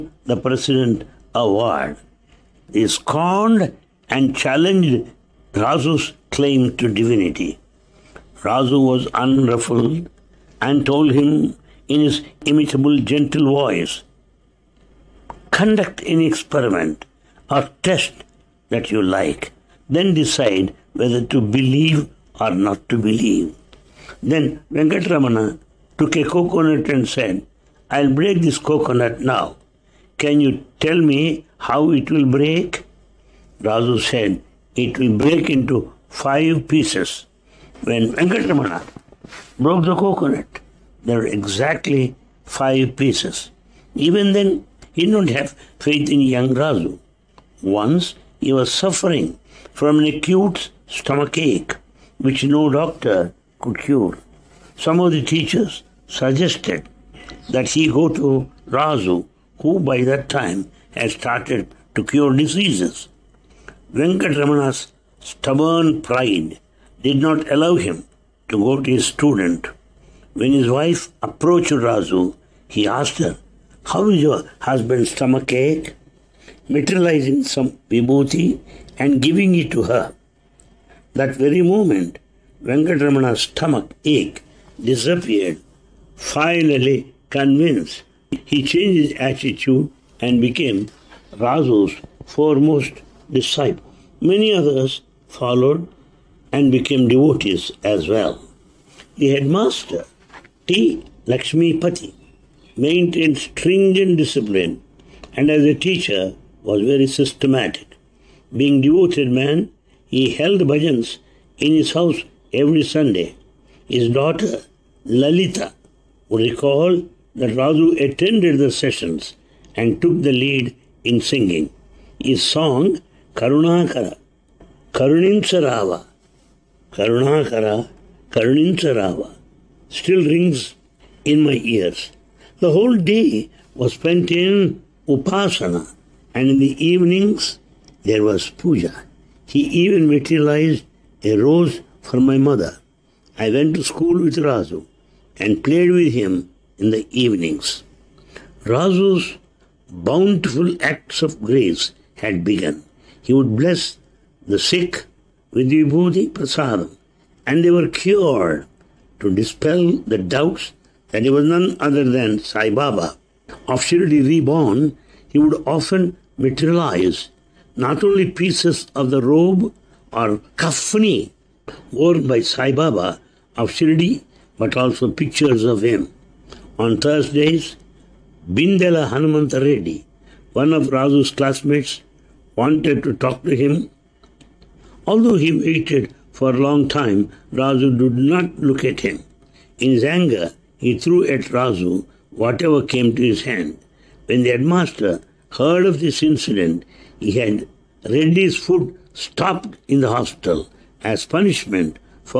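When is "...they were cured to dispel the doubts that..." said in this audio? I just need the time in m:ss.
2:37.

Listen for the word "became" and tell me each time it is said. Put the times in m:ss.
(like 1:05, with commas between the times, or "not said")
1:30, 1:36.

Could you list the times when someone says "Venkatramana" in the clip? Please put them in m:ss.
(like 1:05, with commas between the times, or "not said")
0:24, 0:38, 1:03, 1:22.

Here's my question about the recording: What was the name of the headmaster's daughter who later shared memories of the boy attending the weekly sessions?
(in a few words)
Lalita.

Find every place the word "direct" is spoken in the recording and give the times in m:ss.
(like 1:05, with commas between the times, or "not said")
not said.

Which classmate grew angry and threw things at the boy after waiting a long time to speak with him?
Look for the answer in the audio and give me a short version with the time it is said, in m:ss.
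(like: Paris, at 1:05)
Bindela Hanumanta Reddy, at 2:58.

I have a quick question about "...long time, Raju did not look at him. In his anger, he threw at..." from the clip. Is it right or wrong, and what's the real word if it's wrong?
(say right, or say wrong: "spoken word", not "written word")
right.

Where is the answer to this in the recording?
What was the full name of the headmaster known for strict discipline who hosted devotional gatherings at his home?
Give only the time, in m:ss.
1:40.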